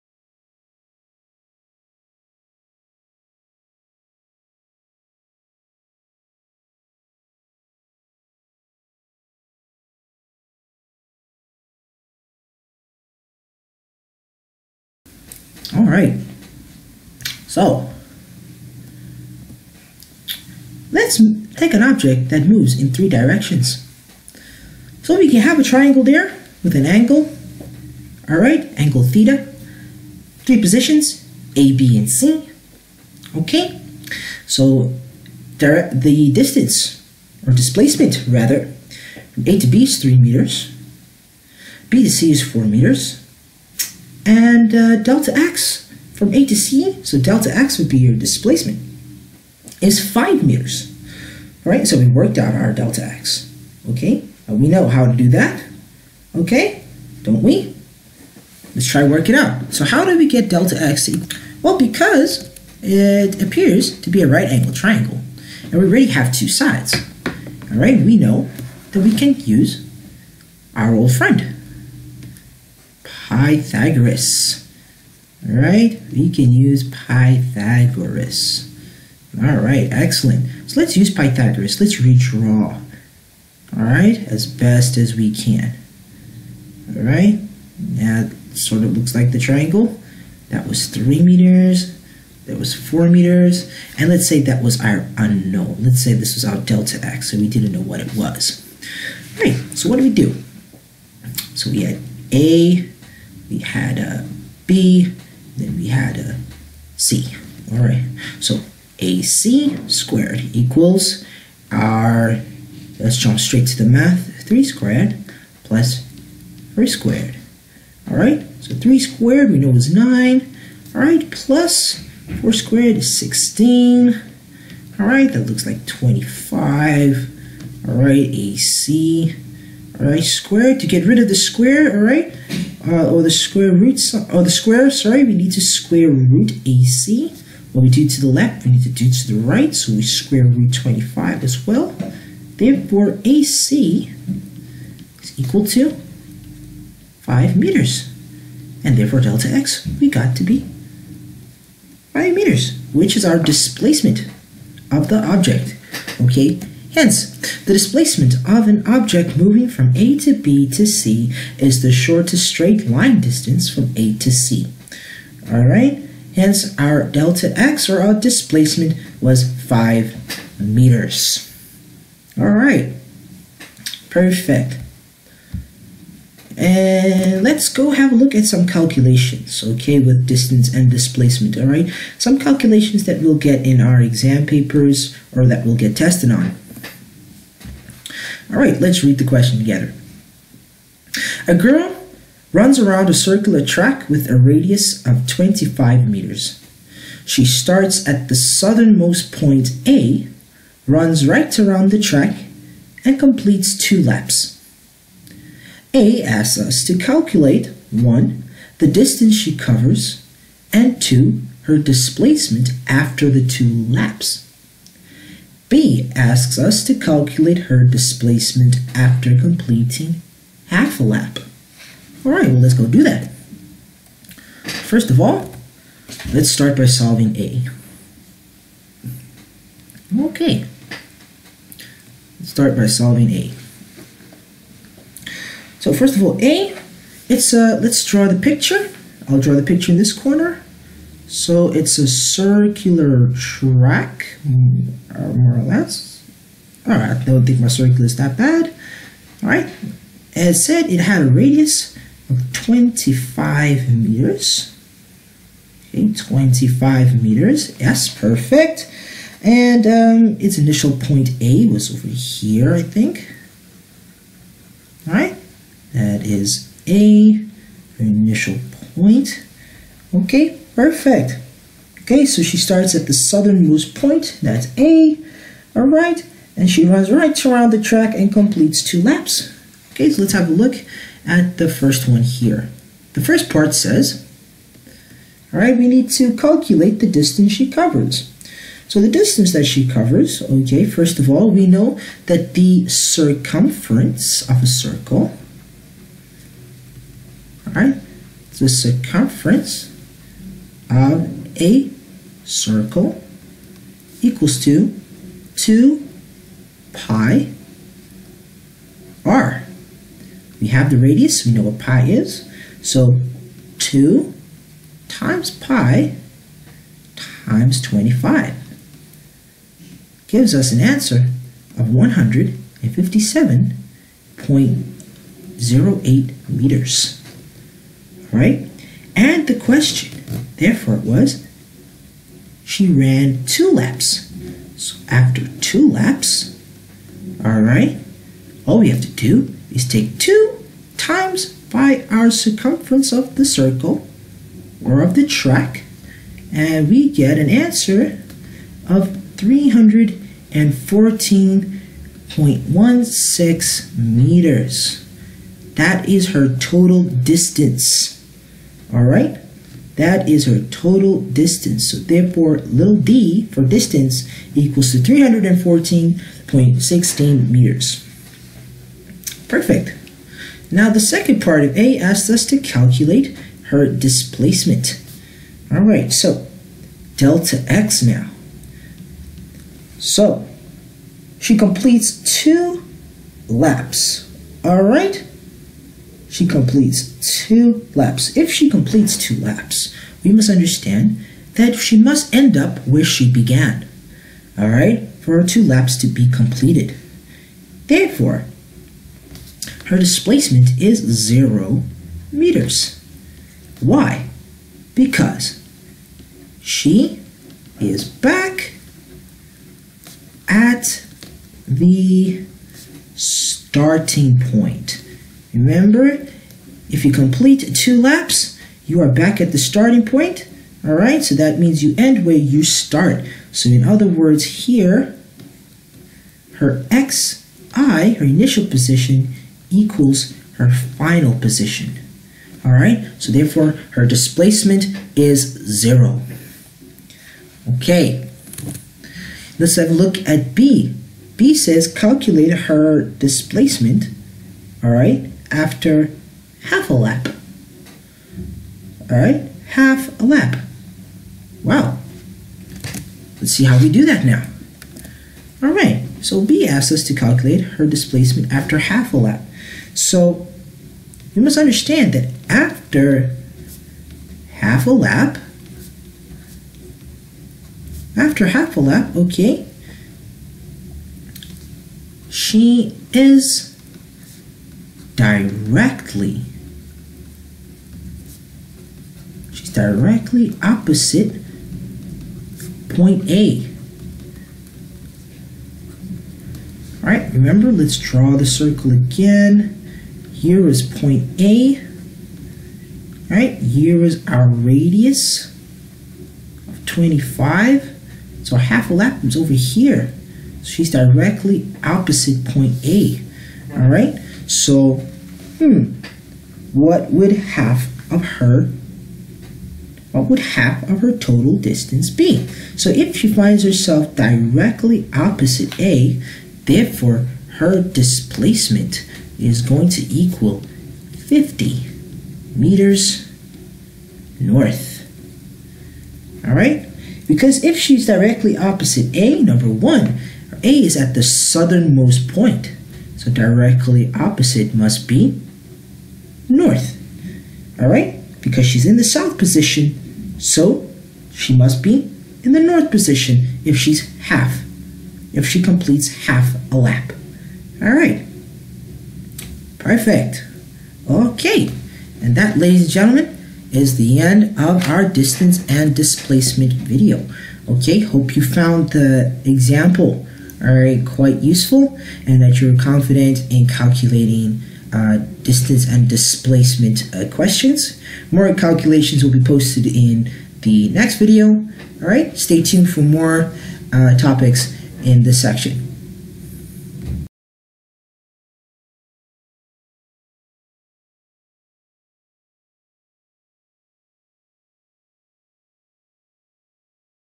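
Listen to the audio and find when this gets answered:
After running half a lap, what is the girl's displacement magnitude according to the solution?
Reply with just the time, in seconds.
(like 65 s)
521 s.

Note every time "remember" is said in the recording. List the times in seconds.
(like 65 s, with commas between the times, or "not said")
415 s, 487 s.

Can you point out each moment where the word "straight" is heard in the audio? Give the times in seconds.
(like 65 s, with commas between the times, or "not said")
113 s, 162 s.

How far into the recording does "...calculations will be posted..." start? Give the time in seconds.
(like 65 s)
568 s.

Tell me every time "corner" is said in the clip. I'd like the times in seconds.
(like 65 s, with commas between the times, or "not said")
240 s.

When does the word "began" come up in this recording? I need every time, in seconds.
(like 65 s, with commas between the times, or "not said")
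393 s.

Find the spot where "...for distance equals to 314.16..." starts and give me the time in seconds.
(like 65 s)
363 s.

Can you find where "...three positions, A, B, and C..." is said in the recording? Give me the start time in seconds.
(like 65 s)
30 s.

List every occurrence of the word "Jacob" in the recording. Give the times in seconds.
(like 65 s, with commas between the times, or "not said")
not said.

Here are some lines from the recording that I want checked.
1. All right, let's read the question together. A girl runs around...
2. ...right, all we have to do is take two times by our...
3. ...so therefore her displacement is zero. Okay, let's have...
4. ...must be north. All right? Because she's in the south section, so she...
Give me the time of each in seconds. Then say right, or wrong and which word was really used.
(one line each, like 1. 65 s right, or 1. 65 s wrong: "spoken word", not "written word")
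1. 188 s right
2. 337 s right
3. 433 s right
4. 534 s wrong: "position", not "section".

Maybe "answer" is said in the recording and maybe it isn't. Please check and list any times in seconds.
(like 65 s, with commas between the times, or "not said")
320 s, 347 s.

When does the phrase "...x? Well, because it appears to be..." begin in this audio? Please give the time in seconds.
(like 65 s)
60 s.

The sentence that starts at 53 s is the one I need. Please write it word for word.
Okay, we know how to do that.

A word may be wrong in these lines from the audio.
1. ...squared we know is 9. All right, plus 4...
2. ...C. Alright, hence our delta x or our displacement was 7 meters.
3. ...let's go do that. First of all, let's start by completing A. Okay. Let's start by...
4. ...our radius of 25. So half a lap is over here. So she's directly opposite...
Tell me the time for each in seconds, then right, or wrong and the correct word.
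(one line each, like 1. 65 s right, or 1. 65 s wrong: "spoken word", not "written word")
1. 118 s right
2. 164 s wrong: "5", not "7"
3. 222 s wrong: "solving", not "completing"
4. 494 s right.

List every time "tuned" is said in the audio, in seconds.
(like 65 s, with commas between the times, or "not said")
572 s.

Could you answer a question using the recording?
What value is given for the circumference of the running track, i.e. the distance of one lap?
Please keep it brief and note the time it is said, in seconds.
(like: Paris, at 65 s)
157.08 meters, at 321 s.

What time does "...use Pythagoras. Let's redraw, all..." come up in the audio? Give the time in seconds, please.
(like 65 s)
80 s.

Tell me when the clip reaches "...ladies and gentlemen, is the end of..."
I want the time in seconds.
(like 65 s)
552 s.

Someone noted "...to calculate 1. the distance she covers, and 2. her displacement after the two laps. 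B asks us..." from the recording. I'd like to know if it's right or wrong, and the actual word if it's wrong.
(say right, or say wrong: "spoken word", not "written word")
right.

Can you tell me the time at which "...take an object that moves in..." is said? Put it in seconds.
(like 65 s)
21 s.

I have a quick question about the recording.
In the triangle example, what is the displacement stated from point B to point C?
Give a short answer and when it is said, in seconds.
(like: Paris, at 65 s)
4 meters, at 41 s.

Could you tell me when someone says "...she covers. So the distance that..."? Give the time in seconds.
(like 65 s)
287 s.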